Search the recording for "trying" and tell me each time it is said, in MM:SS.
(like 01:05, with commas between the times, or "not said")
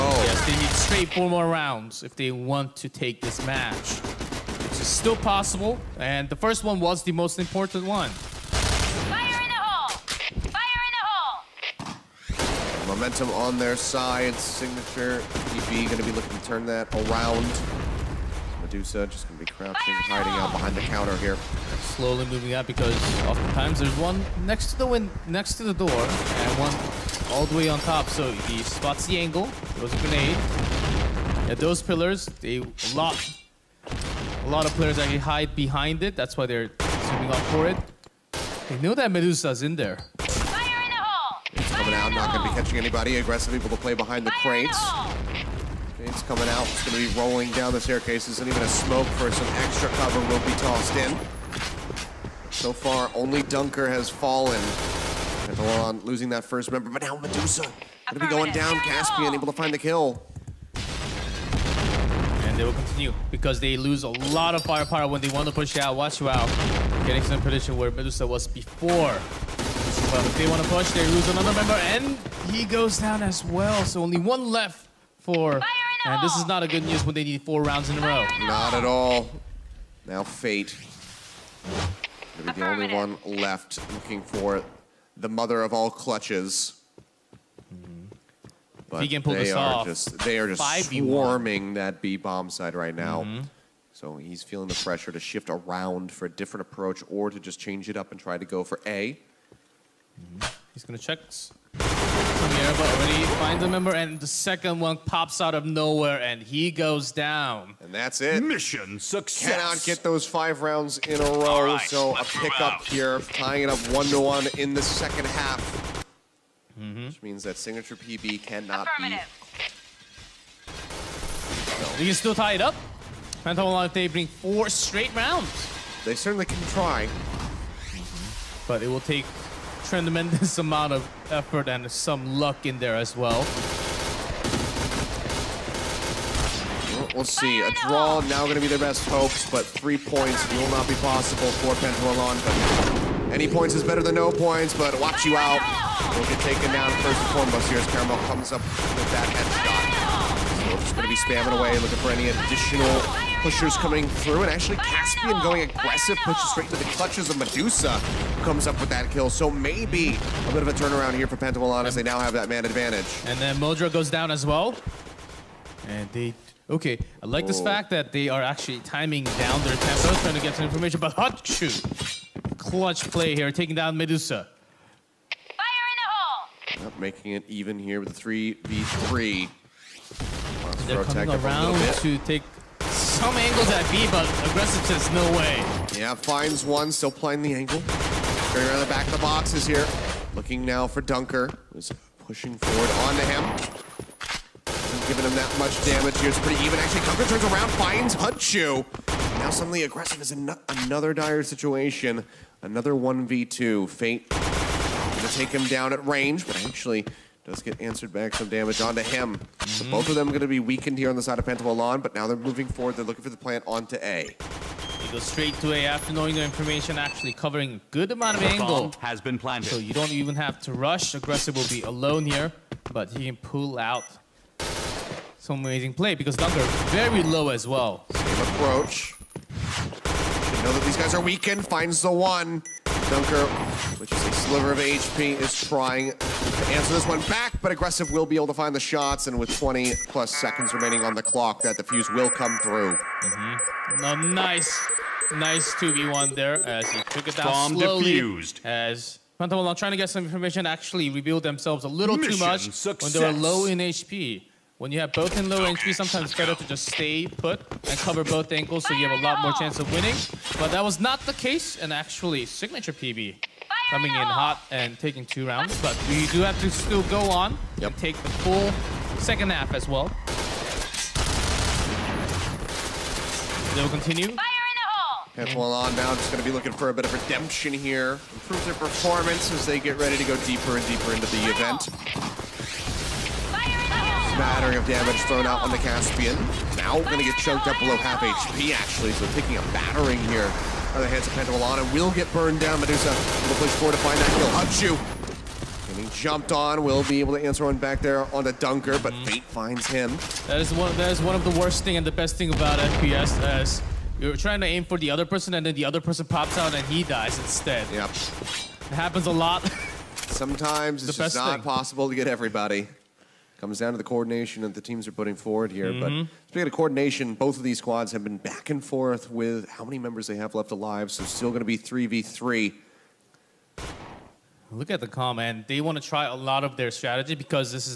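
02:50, 03:55, 04:09, 05:04.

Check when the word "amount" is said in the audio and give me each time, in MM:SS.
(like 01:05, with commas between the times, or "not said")
02:10, 03:38.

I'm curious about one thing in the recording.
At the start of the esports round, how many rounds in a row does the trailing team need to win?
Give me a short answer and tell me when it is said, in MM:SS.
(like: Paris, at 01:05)
4, at 00:01.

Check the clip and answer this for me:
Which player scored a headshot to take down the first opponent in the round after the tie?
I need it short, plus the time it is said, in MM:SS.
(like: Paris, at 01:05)
Caramel, at 02:27.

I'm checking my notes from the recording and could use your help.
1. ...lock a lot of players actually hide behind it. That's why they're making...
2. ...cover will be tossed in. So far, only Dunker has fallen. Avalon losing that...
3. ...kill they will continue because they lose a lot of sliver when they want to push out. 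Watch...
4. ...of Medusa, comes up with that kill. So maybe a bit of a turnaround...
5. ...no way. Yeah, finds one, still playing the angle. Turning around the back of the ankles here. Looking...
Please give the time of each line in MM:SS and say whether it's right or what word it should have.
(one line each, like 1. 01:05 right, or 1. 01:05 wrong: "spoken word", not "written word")
1. 00:32 wrong: "zooming", not "making"
2. 00:49 right
3. 00:59 wrong: "firepower", not "sliver"
4. 02:37 right
5. 03:05 wrong: "boxes", not "ankles".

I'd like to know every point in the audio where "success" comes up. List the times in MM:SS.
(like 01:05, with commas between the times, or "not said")
01:48, 04:12.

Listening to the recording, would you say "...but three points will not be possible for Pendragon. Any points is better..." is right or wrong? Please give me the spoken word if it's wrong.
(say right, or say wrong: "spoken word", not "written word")
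right.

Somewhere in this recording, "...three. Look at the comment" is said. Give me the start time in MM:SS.
05:22.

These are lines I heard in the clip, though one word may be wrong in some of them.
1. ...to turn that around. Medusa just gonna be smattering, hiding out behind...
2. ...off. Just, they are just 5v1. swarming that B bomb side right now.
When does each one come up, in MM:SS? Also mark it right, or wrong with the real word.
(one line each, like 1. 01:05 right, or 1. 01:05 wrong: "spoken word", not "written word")
1. 00:16 wrong: "crouching", not "smattering"
2. 01:29 right.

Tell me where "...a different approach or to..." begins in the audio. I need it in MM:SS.
01:36.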